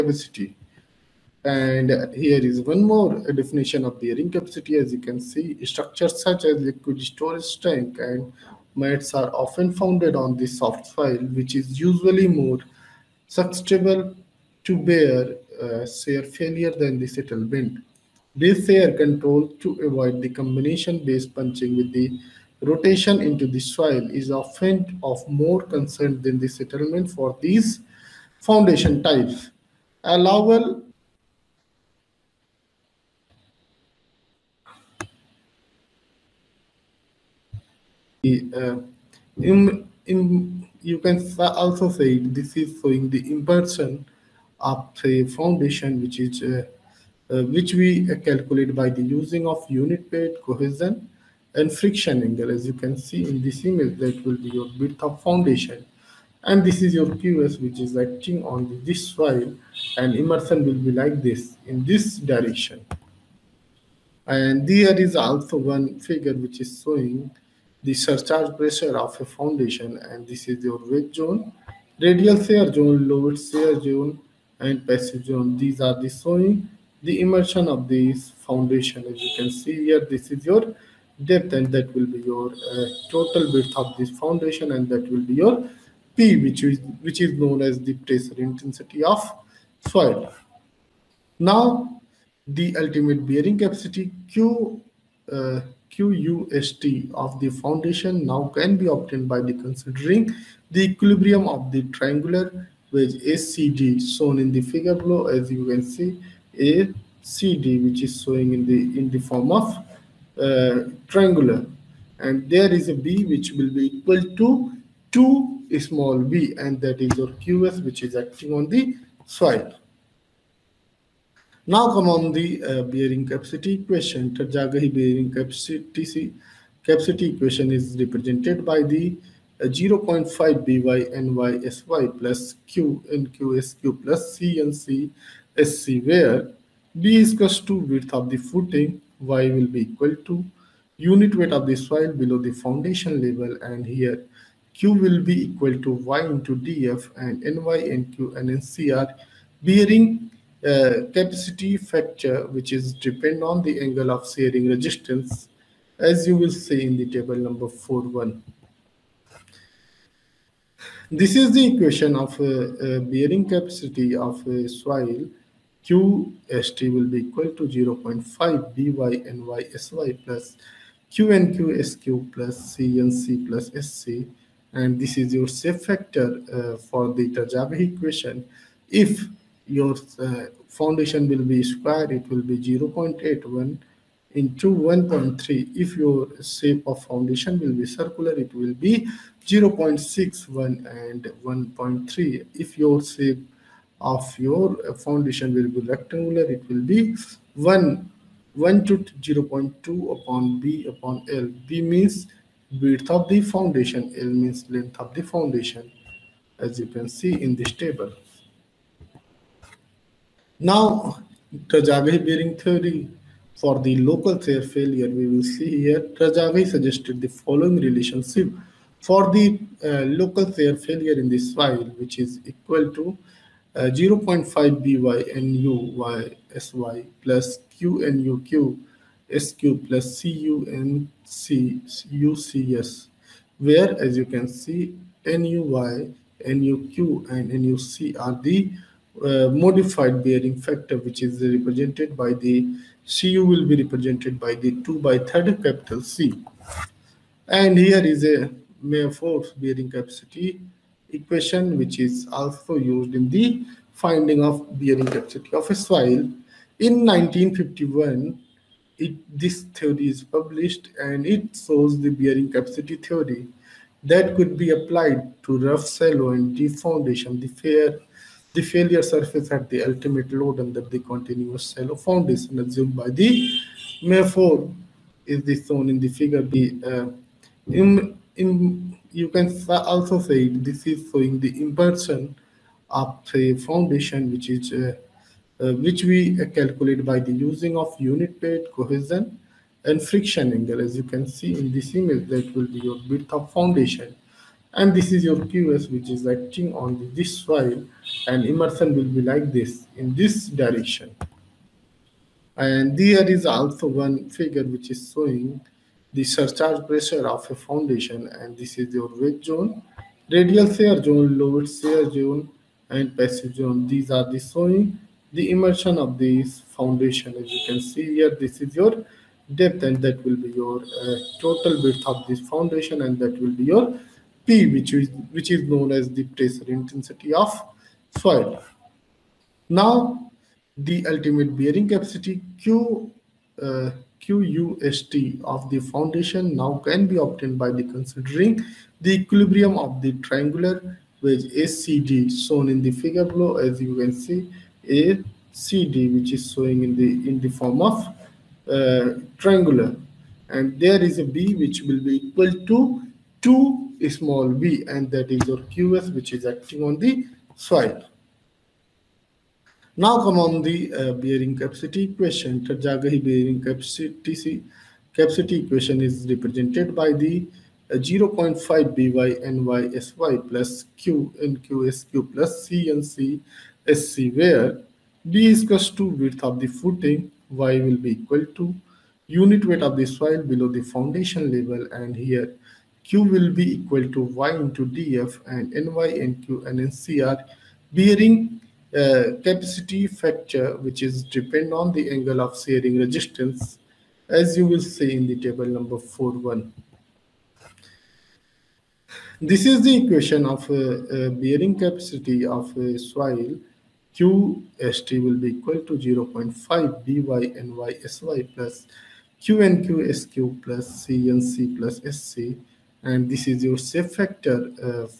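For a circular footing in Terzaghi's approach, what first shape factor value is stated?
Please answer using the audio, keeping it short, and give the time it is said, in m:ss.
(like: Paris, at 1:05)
0.61, at 3:09.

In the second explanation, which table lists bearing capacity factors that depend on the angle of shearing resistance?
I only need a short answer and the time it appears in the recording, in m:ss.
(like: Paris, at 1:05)
Table 4.1, at 6:35.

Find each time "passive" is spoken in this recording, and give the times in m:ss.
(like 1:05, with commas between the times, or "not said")
1:14, 5:13.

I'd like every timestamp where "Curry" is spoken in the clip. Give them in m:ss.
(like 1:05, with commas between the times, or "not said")
not said.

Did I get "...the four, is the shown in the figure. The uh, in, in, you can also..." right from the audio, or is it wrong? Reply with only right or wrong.
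right.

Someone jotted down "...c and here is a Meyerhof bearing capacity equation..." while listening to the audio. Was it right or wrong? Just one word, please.
right.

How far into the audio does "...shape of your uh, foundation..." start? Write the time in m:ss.
3:13.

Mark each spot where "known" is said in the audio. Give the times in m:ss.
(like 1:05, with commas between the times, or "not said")
1:27, 5:25.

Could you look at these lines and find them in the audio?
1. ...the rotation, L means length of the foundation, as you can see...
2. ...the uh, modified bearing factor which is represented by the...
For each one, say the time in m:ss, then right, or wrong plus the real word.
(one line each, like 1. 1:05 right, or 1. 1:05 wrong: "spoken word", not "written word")
1. 3:23 wrong: "foundation", not "rotation"
2. 3:58 right.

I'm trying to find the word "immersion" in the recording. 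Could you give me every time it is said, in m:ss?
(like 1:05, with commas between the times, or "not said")
1:00, 1:17, 4:58, 5:15.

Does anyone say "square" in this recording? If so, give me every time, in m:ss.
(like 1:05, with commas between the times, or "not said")
3:01.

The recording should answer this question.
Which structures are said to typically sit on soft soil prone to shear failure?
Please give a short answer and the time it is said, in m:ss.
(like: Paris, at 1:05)
Liquid storage tank and mats, at 0:06.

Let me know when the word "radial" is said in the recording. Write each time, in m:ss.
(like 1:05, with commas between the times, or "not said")
1:12, 5:10.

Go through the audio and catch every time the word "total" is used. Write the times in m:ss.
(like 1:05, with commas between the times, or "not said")
1:23, 5:21.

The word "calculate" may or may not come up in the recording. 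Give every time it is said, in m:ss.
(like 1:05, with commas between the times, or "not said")
0:48, 4:46.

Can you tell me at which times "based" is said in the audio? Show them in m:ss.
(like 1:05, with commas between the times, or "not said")
0:20.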